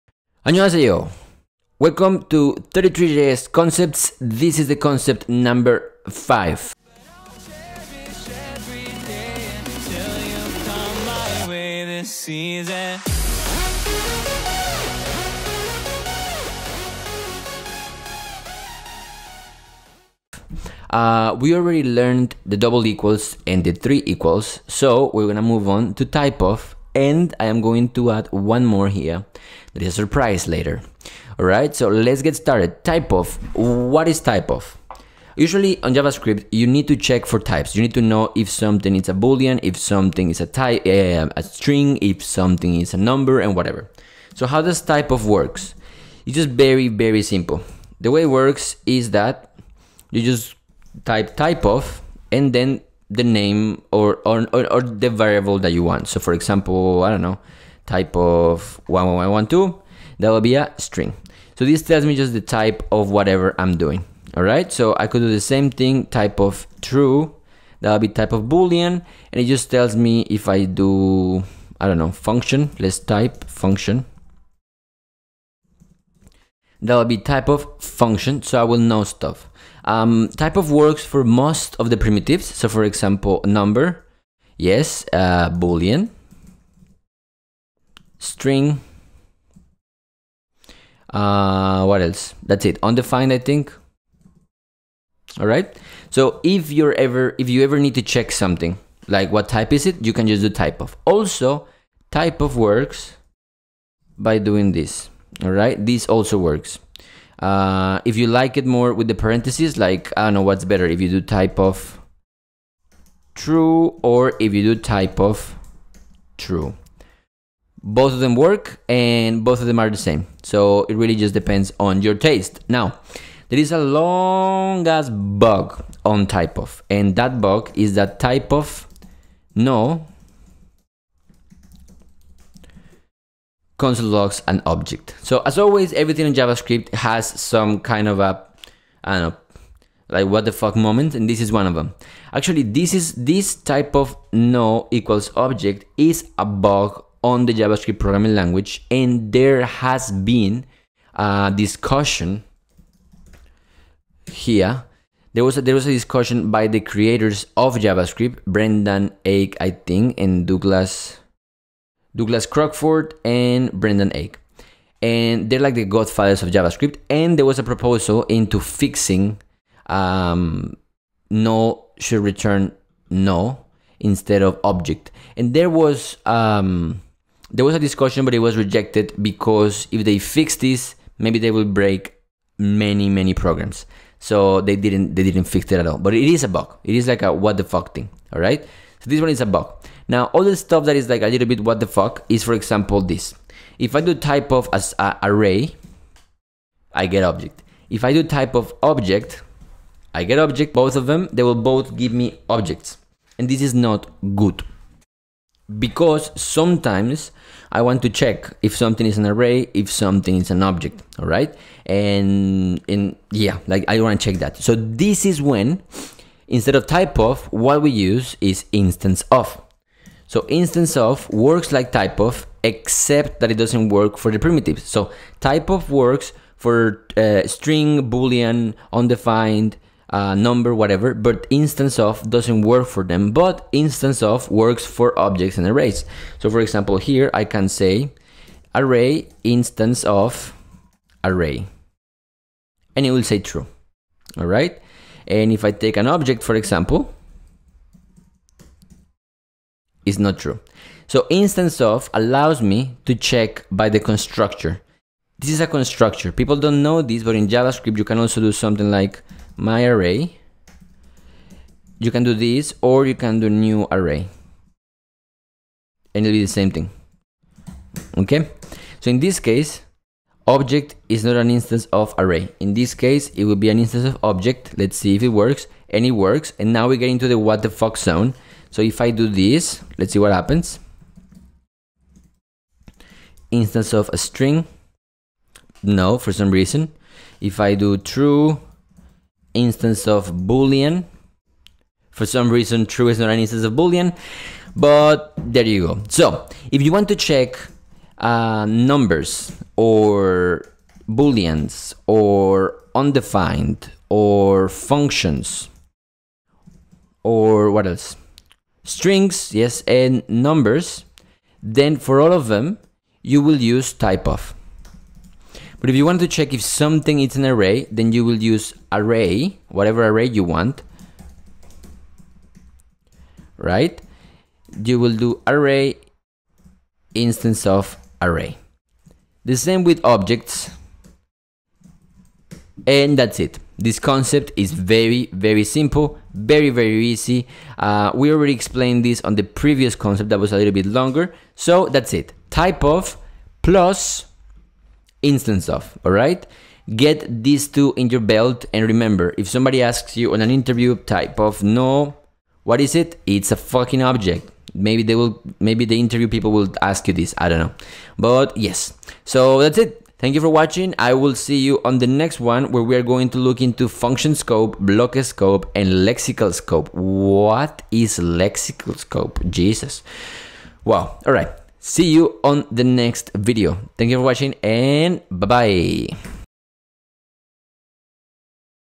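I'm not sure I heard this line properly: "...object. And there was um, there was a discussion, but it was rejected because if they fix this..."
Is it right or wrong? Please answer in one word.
right.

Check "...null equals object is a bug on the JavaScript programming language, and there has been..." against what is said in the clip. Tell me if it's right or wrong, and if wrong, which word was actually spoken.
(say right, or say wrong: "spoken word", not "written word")
right.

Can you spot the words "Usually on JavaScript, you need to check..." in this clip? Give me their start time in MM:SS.
00:35.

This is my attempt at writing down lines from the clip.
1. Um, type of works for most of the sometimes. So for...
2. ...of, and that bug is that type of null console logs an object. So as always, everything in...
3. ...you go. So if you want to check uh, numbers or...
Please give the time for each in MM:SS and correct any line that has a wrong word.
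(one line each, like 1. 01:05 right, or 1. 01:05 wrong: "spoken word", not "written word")
1. 01:19 wrong: "primitives", not "sometimes"
2. 02:06 right
3. 04:55 right.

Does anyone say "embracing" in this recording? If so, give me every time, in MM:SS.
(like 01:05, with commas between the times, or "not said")
not said.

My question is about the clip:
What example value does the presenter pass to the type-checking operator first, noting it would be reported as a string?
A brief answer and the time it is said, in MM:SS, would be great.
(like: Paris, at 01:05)
11112, at 00:58.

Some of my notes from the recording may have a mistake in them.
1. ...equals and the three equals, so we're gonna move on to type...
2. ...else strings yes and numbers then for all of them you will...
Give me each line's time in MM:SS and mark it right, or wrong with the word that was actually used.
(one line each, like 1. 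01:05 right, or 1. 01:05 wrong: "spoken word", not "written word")
1. 00:22 right
2. 05:07 right.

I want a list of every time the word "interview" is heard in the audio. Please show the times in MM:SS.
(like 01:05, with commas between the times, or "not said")
05:50, 05:55.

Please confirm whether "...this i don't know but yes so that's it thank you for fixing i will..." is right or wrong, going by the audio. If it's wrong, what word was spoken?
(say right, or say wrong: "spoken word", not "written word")
wrong: "watching", not "fixing".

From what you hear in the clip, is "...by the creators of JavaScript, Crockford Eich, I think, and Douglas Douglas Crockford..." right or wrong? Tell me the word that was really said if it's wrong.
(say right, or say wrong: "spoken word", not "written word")
wrong: "Brendan", not "Crockford".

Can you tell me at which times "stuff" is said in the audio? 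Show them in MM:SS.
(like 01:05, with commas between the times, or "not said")
01:19, 03:10.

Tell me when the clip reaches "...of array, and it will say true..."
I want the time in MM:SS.
04:00.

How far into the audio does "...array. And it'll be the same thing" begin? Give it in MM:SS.
04:23.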